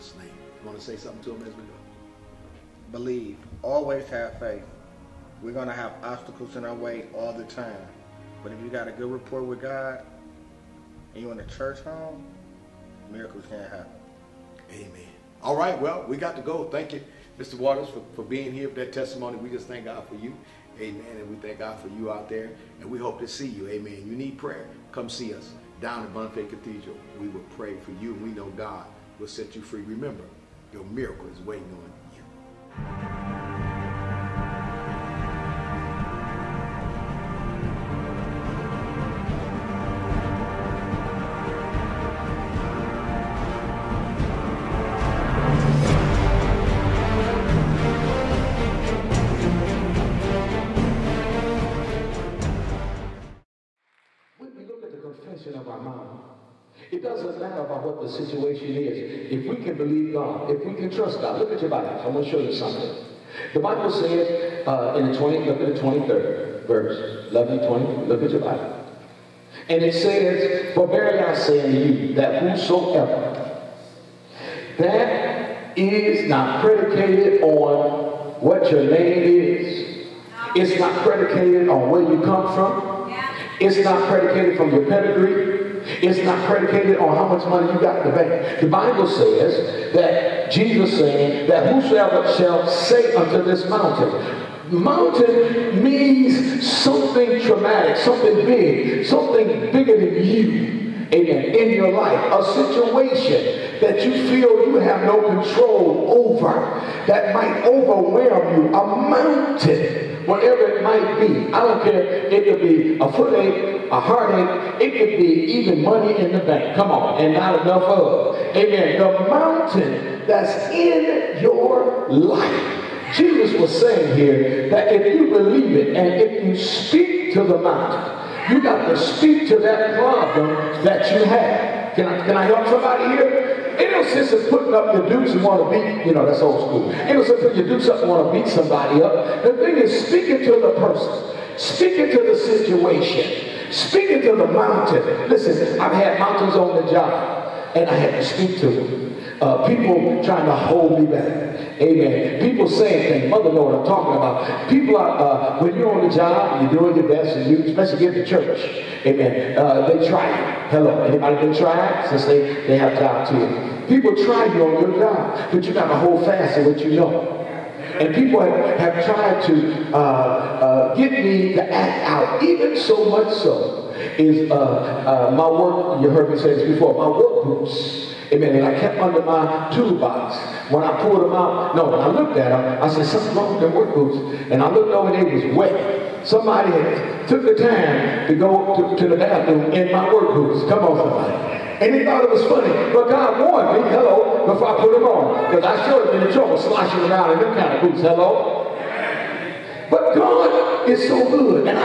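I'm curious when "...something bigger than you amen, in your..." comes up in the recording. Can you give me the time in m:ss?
1:39.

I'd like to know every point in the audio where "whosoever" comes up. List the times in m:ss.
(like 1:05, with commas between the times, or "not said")
1:12, 1:31.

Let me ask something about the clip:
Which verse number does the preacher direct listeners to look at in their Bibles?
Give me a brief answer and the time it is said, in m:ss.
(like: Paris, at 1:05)
23rd verse, at 1:05.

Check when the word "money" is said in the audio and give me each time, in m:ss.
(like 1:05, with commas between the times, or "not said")
1:27, 1:55.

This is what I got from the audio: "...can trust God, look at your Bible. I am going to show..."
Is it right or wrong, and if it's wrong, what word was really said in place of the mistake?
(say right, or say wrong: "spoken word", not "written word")
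right.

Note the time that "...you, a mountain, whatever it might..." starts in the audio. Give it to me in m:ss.
1:48.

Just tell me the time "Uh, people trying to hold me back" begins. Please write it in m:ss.
2:29.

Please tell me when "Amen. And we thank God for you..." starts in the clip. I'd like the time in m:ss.
0:20.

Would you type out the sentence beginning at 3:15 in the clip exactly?
Because I showed him in the trouble, sloshing around in them kind of boots.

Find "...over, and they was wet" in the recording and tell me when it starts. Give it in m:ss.
3:04.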